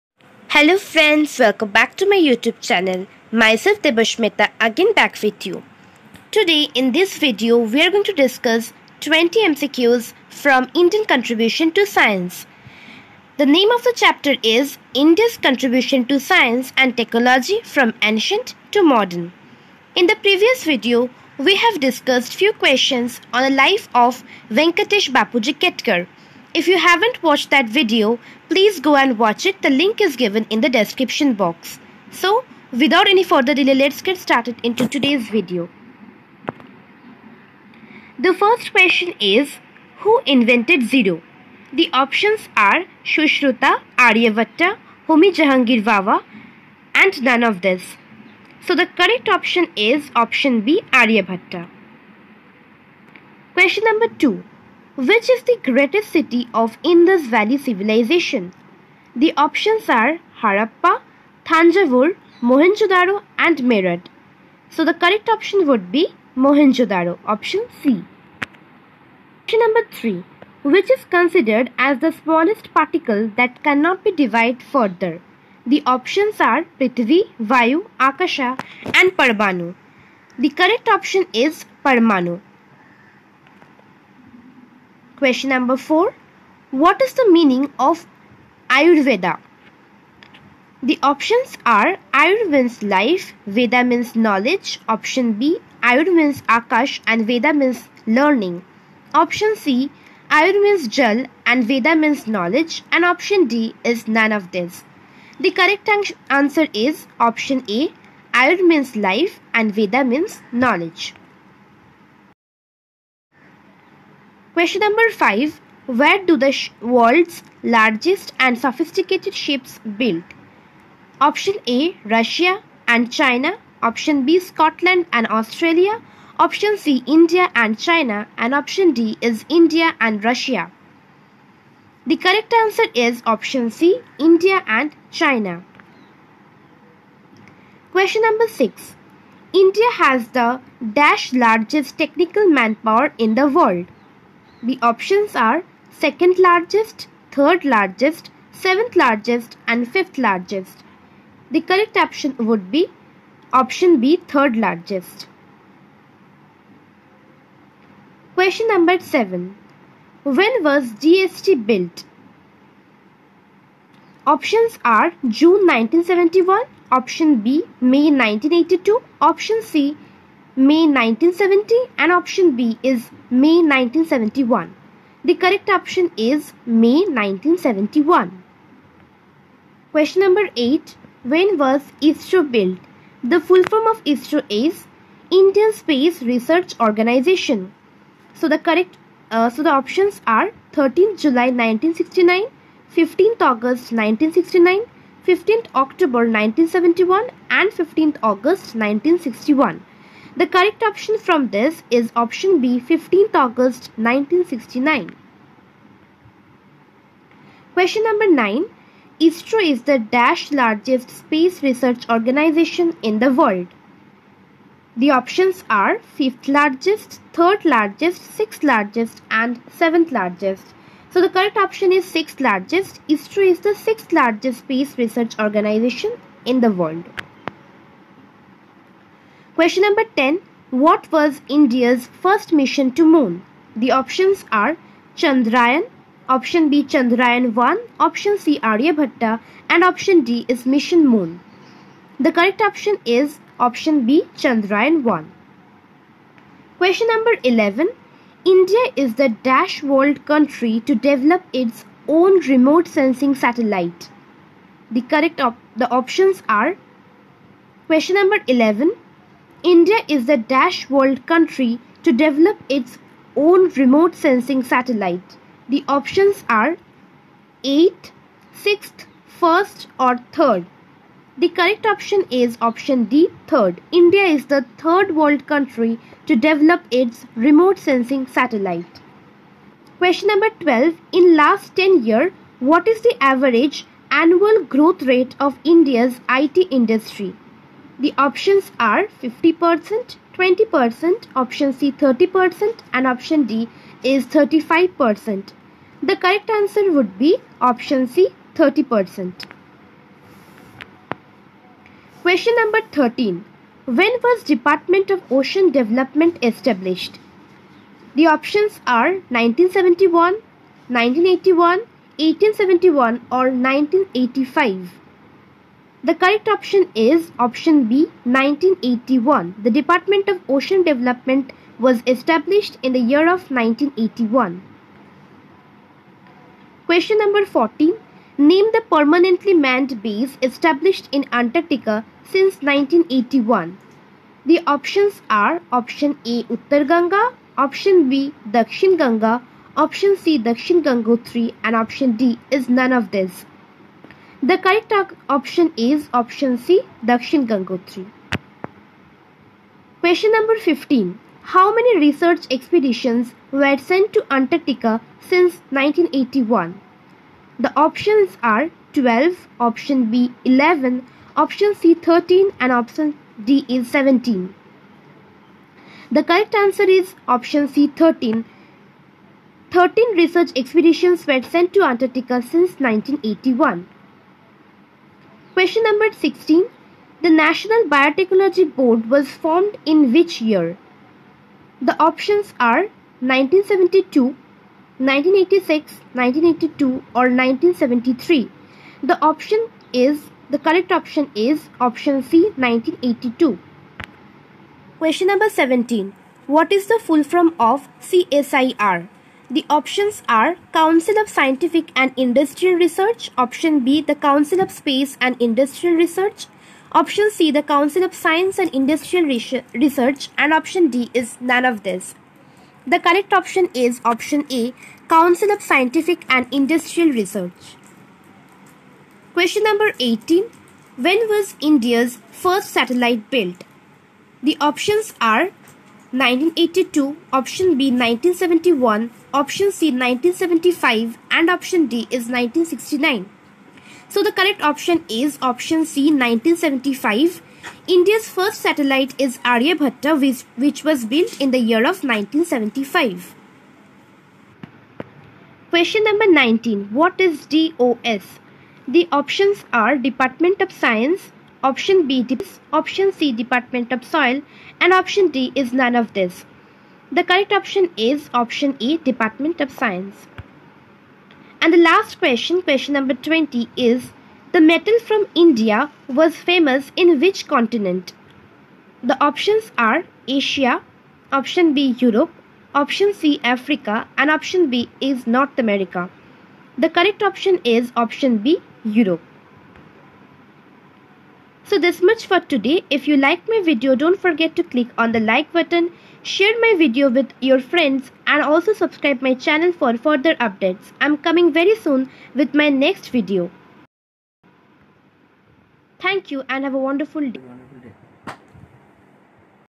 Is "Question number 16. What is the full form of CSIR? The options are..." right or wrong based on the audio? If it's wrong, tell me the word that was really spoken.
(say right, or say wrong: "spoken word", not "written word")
wrong: "17", not "16".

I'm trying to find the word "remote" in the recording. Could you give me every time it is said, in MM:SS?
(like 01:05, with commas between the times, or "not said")
04:12, 04:23, 04:37.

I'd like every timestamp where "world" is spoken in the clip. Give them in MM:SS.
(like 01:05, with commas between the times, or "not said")
01:56, 02:23, 03:33, 03:46, 04:09, 04:20, 04:35.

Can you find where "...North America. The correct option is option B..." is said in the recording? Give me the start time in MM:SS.
07:55.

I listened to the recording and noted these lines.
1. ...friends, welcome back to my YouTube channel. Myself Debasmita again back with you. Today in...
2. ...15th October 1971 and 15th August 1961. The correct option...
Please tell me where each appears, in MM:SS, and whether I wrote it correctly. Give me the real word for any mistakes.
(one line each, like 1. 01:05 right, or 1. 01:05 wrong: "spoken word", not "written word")
1. 00:00 right
2. 03:15 right.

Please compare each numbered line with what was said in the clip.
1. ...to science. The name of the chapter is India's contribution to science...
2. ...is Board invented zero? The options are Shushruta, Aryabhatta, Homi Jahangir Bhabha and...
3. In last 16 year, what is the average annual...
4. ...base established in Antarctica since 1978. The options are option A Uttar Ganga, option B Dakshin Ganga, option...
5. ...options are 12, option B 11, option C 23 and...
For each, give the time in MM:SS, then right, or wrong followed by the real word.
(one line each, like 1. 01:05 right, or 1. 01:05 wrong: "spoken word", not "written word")
1. 00:11 right
2. 00:39 wrong: "Who", not "Board"
3. 04:41 wrong: "10", not "16"
4. 05:30 wrong: "1981", not "1978"
5. 05:57 wrong: "13", not "23".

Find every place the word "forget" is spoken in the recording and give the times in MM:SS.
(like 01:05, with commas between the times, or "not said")
08:04.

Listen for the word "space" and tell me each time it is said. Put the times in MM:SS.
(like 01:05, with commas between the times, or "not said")
03:05, 03:31, 03:44, 06:44.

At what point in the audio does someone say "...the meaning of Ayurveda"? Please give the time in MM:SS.
01:27.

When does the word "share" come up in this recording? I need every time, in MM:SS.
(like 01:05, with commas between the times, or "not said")
08:06.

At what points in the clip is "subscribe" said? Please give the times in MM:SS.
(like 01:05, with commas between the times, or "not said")
08:08.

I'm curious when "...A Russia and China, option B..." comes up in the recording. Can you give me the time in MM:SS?
02:01.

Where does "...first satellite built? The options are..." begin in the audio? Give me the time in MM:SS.
07:02.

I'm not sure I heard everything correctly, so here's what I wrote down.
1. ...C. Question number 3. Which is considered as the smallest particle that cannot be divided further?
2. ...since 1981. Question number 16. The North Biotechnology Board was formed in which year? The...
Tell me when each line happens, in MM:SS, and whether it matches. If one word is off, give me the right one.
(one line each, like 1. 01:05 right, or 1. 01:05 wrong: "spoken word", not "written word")
1. 01:07 right
2. 06:12 wrong: "National", not "North".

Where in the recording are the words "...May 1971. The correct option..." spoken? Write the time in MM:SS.
02:53.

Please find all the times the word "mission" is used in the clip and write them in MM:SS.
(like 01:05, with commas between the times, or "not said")
03:52, 04:00.